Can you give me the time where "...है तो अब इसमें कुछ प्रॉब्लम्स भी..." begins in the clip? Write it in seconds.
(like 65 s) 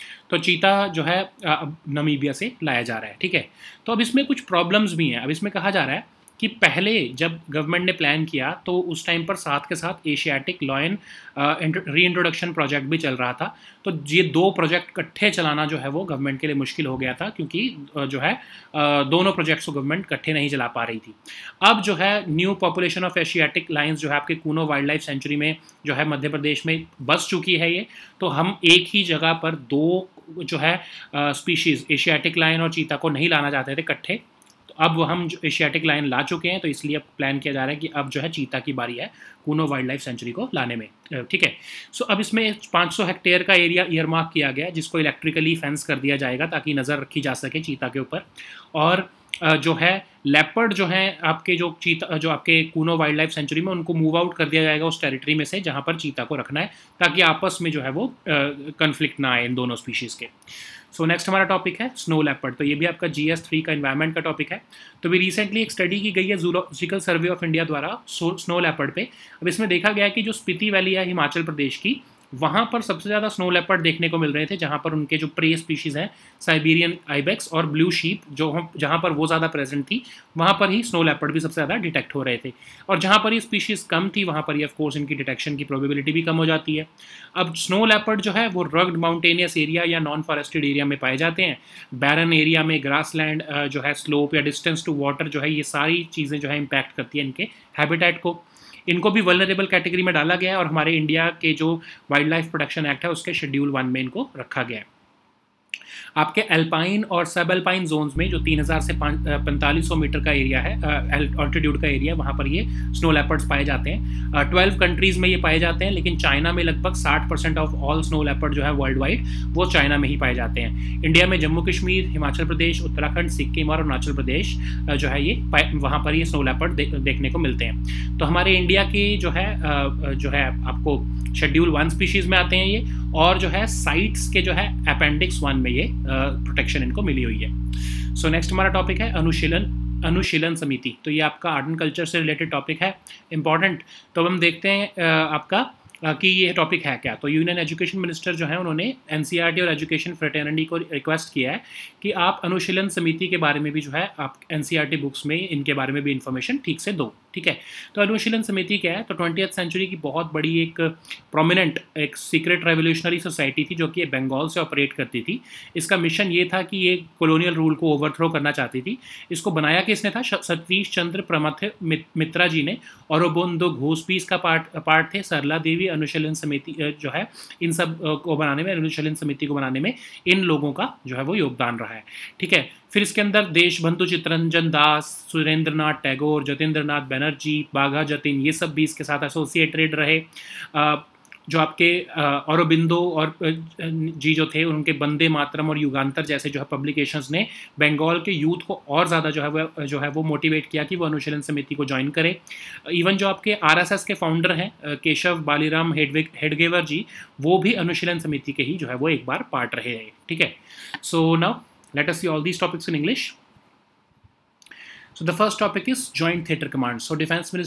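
3 s.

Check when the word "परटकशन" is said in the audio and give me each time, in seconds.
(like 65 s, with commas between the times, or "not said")
102 s, 136 s.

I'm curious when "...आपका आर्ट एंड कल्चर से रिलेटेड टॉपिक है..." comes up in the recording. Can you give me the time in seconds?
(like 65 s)
141 s.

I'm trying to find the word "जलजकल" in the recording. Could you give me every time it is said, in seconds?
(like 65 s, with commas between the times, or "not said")
66 s.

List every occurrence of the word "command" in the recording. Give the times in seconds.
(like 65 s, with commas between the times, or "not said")
216 s.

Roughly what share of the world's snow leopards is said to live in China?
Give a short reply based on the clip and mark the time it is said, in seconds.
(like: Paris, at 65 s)
60 percent, at 117 s.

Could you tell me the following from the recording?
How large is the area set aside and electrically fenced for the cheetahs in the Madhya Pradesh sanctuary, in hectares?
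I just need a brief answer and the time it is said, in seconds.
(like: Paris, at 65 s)
500 hectares, at 42 s.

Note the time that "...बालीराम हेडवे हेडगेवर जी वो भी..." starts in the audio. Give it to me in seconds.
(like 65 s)
205 s.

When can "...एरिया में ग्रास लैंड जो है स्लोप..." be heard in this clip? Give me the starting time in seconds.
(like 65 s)
92 s.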